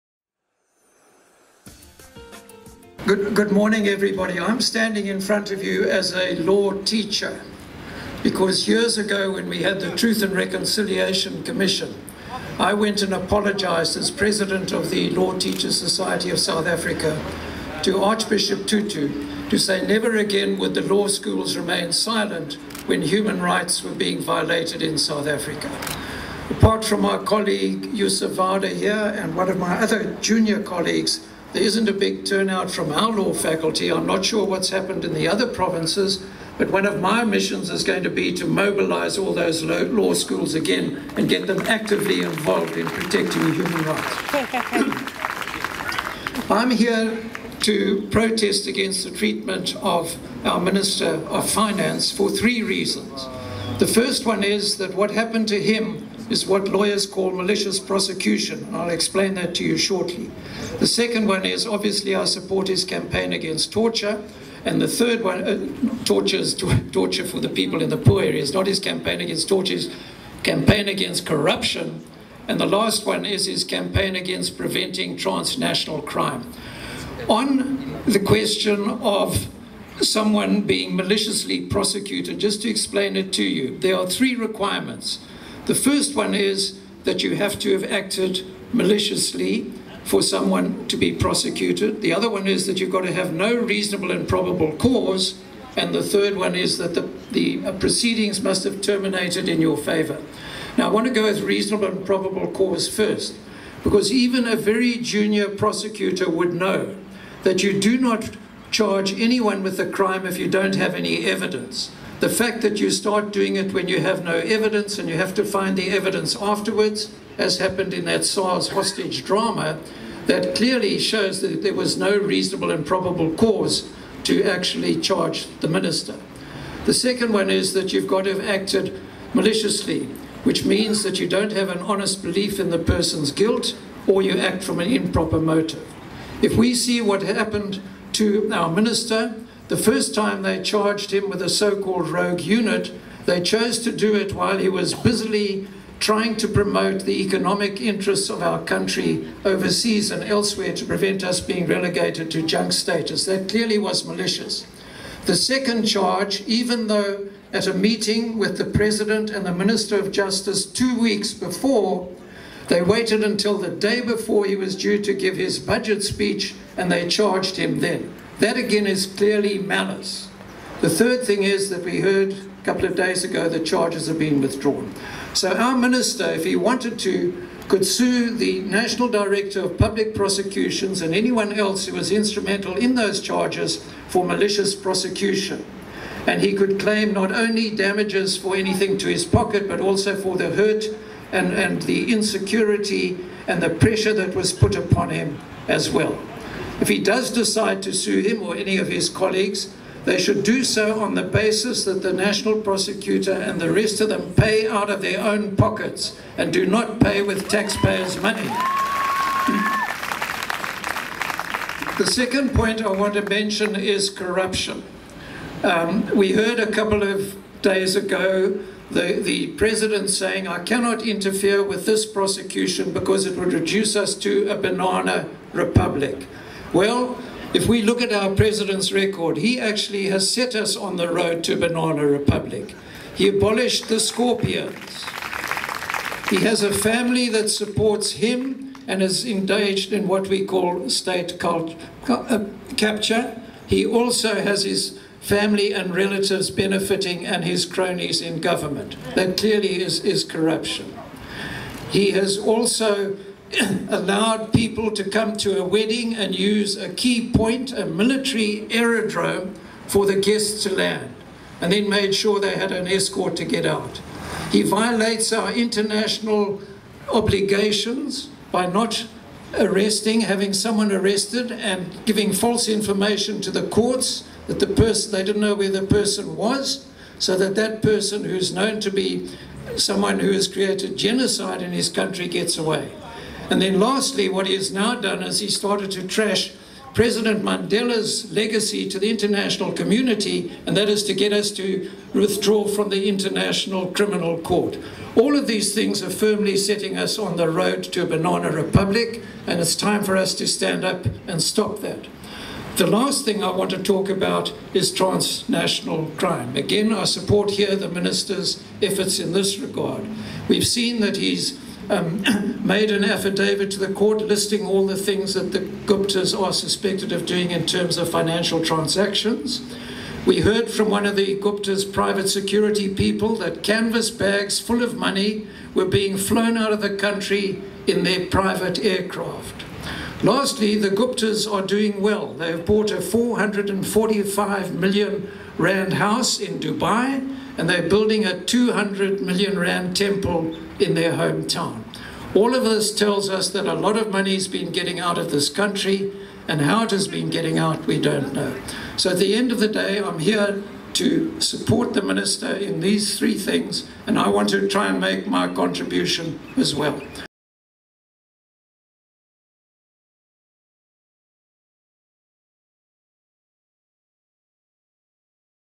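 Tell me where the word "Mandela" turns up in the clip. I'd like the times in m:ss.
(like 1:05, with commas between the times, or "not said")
4:47.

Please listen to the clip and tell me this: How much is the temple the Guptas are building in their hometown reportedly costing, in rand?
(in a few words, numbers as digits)
200 million rand.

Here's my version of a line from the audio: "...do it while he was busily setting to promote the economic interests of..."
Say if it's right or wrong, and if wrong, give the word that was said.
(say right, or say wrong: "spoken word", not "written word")
wrong: "trying", not "setting".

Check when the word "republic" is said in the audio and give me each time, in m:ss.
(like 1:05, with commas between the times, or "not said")
3:45, 3:52, 4:58.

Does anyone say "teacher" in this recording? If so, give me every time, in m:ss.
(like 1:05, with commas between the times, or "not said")
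0:06, 0:15.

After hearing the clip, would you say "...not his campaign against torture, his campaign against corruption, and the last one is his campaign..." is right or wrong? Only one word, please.
right.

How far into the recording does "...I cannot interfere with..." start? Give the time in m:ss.
3:40.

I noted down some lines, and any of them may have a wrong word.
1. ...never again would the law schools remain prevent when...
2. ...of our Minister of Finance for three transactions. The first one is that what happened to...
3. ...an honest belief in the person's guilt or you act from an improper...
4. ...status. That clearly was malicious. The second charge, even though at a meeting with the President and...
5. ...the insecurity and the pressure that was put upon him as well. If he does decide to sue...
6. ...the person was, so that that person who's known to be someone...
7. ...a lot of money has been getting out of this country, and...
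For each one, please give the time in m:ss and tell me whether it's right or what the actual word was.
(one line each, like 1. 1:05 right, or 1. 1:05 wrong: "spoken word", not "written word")
1. 0:19 wrong: "silent", not "prevent"
2. 0:49 wrong: "reasons", not "transactions"
3. 2:11 right
4. 2:32 right
5. 3:11 right
6. 4:35 right
7. 5:43 right.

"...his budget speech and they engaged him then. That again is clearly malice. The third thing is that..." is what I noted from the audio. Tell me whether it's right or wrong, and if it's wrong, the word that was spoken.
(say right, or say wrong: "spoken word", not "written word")
wrong: "charged", not "engaged".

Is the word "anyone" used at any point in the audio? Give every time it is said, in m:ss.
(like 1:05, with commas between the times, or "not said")
1:49, 3:01.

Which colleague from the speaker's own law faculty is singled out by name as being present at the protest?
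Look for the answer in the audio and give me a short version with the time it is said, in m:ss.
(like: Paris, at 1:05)
Yusuf Vawda, at 0:27.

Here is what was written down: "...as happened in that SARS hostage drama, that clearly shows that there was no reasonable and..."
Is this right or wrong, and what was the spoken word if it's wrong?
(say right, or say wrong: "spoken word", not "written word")
right.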